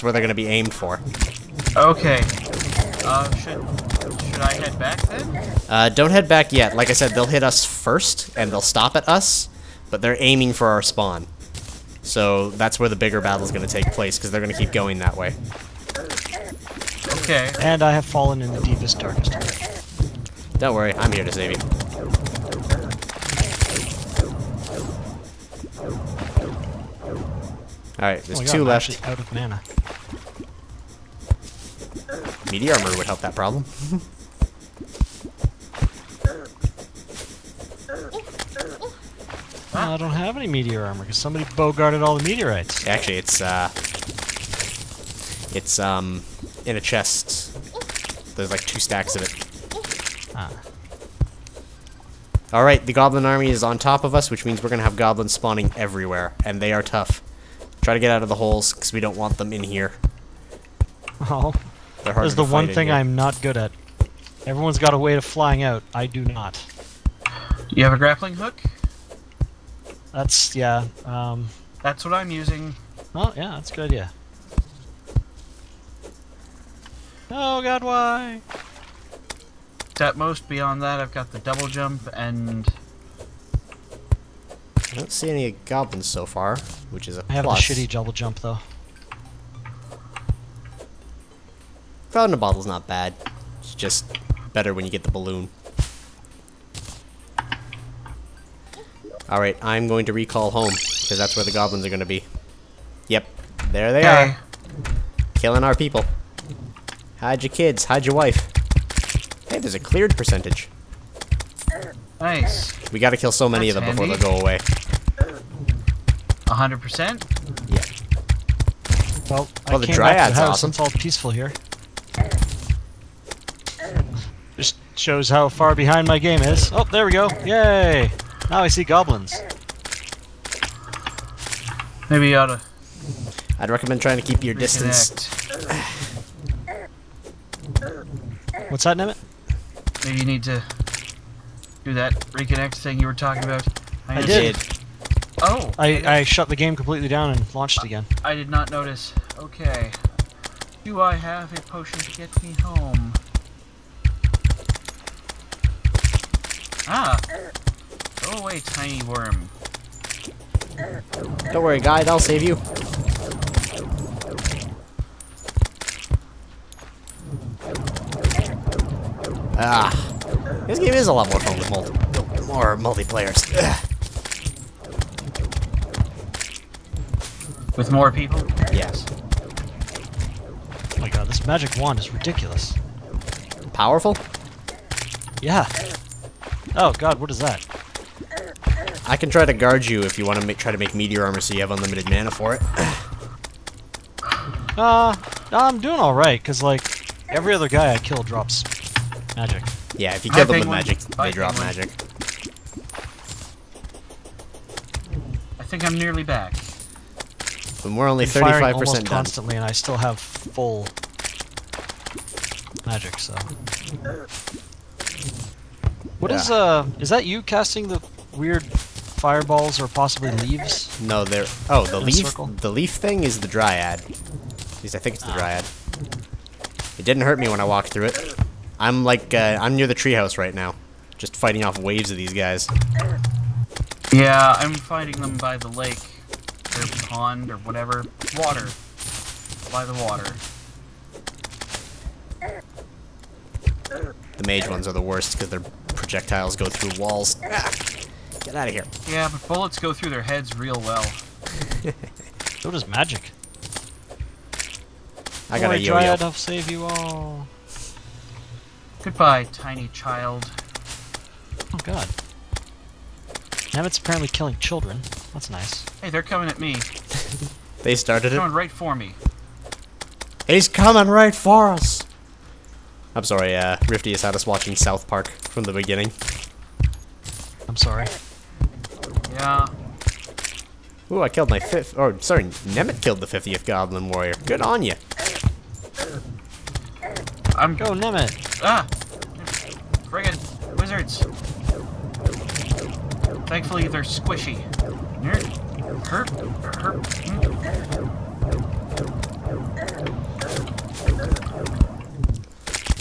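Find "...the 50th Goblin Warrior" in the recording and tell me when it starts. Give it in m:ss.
4:43.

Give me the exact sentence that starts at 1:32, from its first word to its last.
Cloud in a bottle's not bad.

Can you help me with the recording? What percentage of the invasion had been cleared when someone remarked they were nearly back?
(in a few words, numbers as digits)
35%.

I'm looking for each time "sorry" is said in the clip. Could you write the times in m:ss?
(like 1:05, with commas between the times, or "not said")
4:33, 4:37, 4:42.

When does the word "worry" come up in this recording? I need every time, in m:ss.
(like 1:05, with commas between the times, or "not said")
0:20, 2:41.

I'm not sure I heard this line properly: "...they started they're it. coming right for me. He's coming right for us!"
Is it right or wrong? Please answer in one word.
right.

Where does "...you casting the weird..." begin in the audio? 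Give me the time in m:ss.
3:37.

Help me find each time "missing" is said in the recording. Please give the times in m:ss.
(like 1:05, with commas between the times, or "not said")
not said.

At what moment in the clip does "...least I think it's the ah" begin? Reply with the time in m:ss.
3:44.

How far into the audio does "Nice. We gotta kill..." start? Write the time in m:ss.
1:52.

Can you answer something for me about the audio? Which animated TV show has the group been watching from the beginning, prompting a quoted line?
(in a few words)
South Park.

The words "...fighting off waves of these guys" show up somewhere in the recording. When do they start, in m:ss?
3:51.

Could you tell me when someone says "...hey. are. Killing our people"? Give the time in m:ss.
1:44.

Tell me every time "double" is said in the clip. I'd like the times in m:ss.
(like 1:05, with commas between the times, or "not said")
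1:21, 1:27.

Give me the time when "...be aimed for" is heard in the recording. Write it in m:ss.
0:00.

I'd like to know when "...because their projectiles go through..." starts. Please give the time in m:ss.
4:05.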